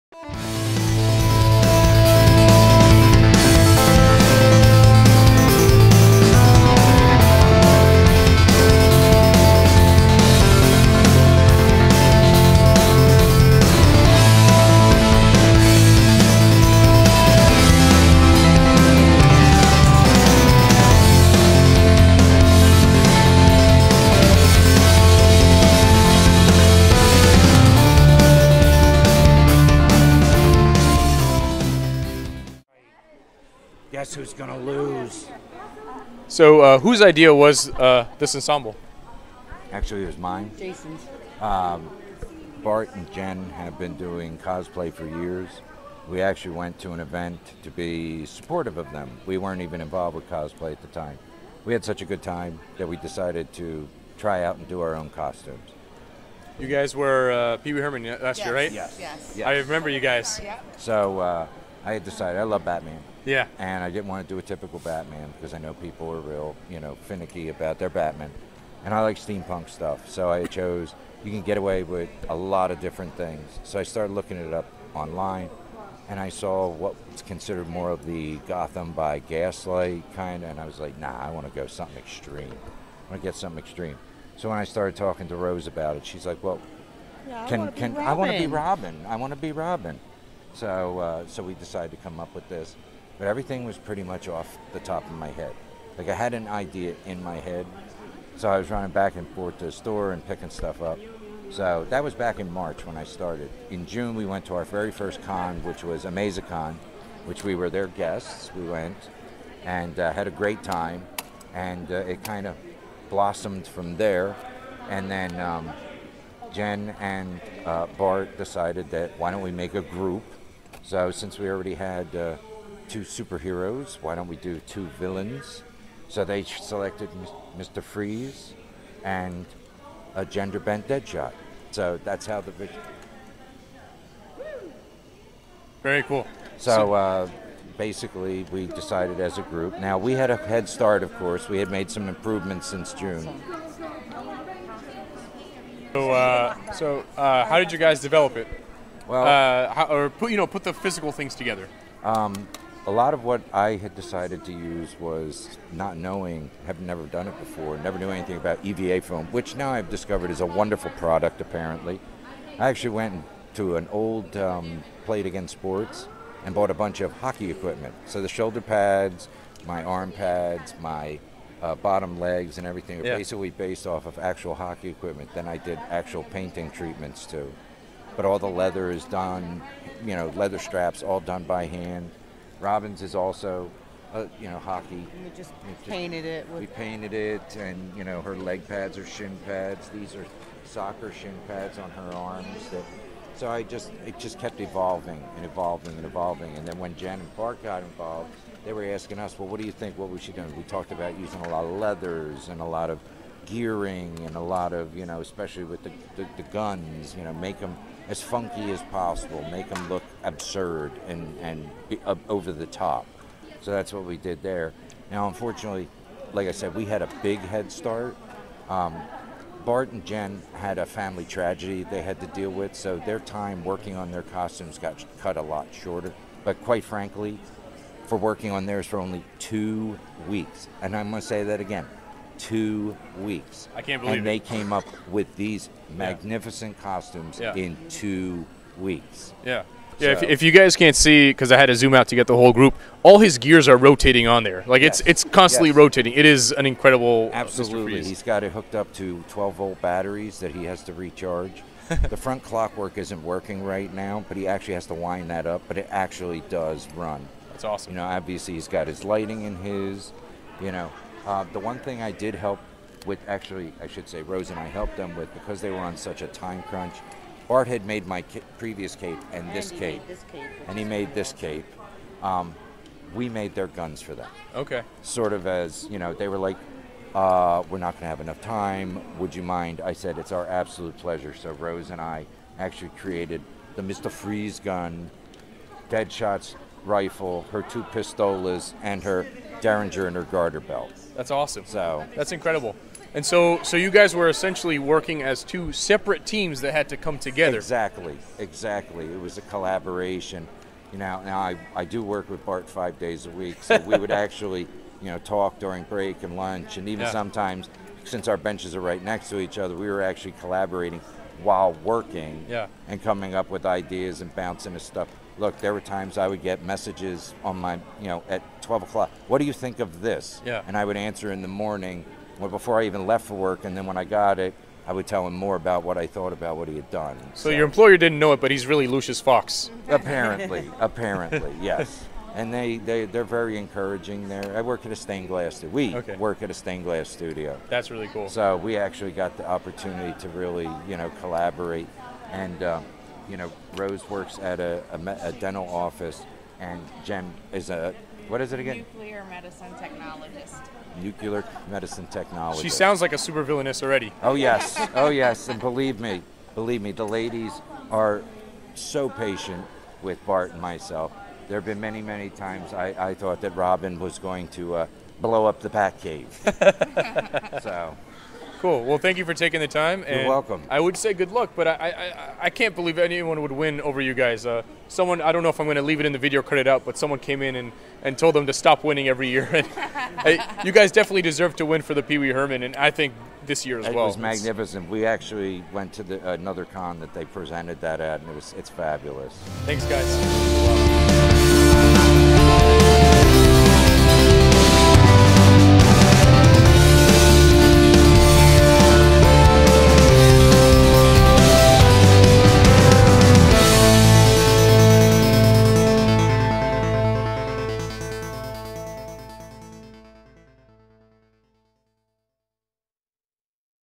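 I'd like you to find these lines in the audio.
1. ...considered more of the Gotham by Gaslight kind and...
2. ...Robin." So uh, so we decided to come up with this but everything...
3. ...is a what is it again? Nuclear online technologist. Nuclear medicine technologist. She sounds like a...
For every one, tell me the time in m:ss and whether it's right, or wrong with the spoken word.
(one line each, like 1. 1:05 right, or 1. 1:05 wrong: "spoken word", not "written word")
1. 1:17 right
2. 1:29 right
3. 5:47 wrong: "medicine", not "online".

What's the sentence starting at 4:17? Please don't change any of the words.
You know, obviously he's got his lighting in his.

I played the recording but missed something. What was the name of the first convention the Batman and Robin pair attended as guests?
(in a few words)
AmazaCon.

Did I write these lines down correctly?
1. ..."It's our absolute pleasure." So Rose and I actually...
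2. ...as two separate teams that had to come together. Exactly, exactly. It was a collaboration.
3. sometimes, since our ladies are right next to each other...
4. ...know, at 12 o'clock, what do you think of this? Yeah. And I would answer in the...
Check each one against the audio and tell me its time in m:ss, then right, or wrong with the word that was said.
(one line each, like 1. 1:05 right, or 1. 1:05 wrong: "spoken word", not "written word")
1. 4:40 right
2. 4:55 right
3. 5:07 wrong: "benches", not "ladies"
4. 5:18 right.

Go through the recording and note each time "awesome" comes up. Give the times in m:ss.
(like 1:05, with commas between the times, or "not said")
4:17, 4:51.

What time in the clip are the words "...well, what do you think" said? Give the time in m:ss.
3:19.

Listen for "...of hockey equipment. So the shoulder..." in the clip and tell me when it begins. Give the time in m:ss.
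2:47.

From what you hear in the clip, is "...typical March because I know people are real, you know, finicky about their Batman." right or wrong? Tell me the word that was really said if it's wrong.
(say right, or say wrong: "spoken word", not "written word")
wrong: "Batman", not "March".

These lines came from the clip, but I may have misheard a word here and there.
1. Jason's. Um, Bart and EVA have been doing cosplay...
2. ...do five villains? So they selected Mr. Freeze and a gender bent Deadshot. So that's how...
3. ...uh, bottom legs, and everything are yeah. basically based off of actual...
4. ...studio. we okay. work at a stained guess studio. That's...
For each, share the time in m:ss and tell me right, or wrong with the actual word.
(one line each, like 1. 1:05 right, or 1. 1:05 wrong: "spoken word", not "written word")
1. 0:40 wrong: "Jen", not "EVA"
2. 2:04 wrong: "two", not "five"
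3. 2:51 right
4. 5:35 wrong: "glass", not "guess".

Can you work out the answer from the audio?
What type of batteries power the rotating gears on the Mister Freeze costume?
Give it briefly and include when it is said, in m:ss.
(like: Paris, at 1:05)
12 volt, at 4:09.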